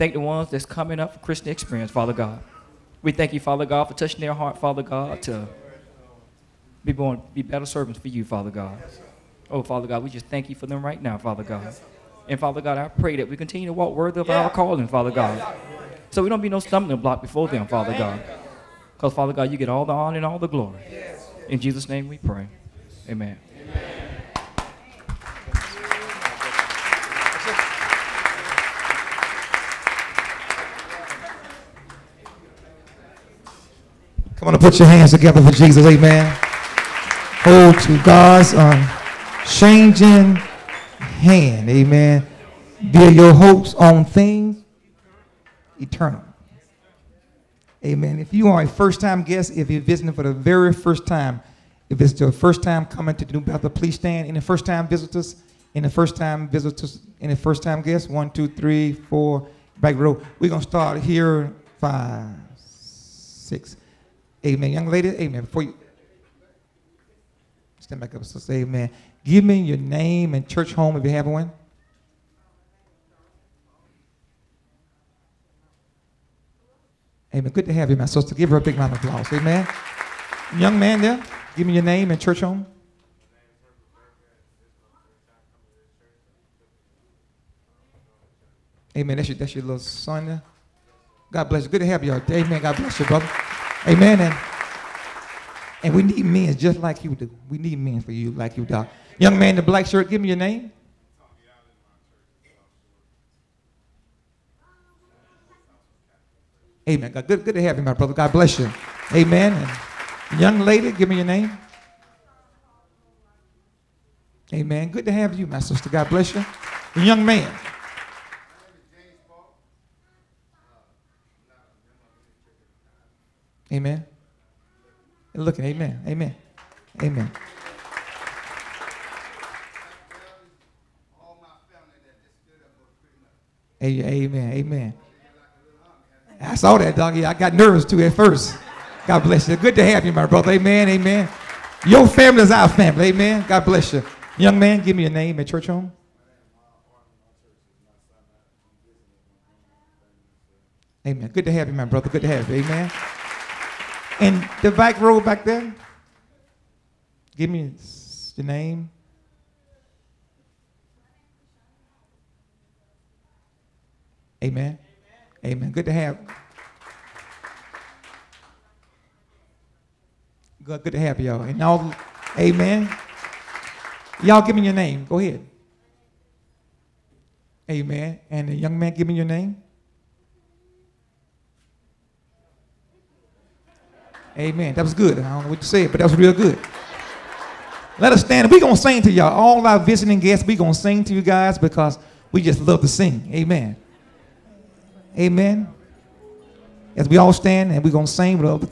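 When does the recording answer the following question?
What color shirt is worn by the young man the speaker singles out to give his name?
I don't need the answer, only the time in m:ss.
1:39.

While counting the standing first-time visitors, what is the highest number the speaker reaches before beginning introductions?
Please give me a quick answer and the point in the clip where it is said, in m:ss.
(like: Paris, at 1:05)
6, at 1:02.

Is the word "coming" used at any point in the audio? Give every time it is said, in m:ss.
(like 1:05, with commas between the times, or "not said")
0:00, 0:52.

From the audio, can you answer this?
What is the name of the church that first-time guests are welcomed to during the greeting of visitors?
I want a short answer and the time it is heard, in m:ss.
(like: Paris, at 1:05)
New Bethel, at 0:53.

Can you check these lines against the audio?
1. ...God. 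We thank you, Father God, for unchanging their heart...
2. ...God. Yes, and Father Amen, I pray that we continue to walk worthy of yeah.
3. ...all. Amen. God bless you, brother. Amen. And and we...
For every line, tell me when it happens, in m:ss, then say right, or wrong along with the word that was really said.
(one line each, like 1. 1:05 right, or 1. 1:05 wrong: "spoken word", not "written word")
1. 0:02 wrong: "touching", not "unchanging"
2. 0:11 wrong: "God", not "Amen"
3. 1:32 right.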